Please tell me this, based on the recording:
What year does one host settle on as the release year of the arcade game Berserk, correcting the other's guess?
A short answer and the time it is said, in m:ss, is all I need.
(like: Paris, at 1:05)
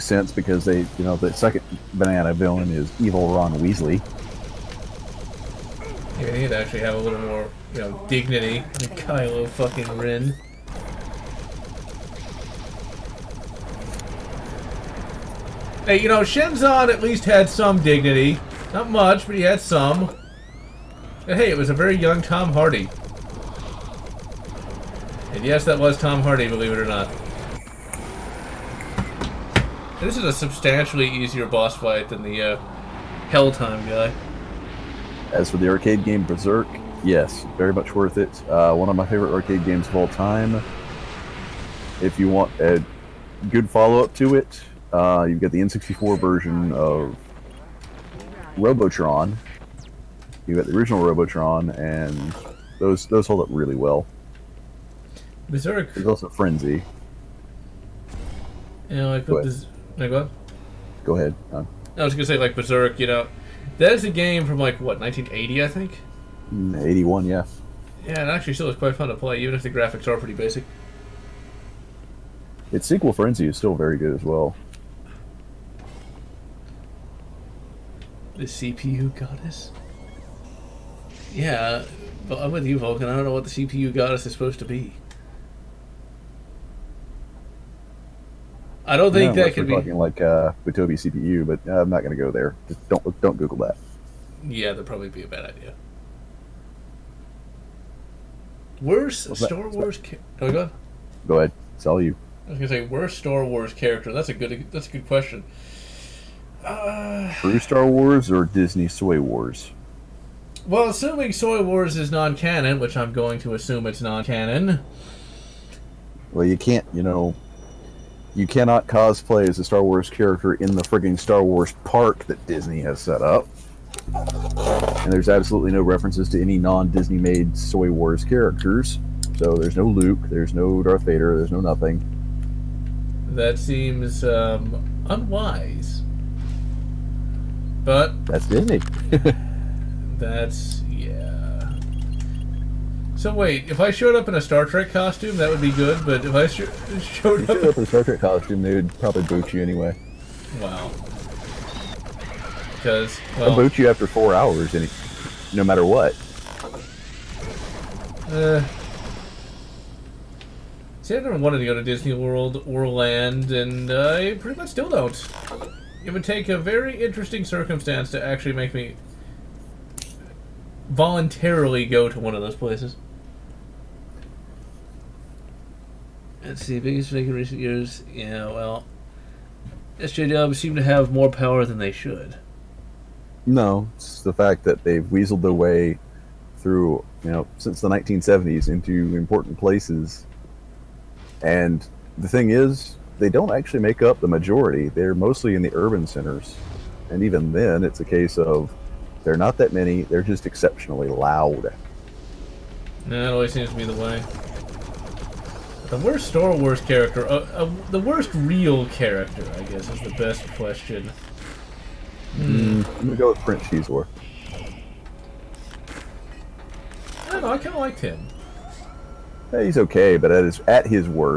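1981, at 1:06.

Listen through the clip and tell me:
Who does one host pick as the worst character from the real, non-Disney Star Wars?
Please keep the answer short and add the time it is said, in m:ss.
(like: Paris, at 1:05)
Prince Xizor, at 3:33.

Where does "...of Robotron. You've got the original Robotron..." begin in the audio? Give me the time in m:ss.
0:46.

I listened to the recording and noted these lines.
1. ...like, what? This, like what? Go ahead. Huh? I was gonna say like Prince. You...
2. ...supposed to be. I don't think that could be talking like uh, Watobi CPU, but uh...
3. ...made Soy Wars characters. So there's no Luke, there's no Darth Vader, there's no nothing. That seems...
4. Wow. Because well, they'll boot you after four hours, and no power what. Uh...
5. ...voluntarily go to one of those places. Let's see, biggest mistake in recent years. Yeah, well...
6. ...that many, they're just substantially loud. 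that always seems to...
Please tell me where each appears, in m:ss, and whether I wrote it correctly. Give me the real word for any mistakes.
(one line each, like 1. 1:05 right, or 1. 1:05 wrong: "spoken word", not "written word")
1. 0:59 wrong: "Berserk", not "Prince"
2. 1:24 right
3. 2:07 right
4. 2:30 wrong: "matter", not "power"
5. 2:50 right
6. 3:19 wrong: "exceptionally", not "substantially".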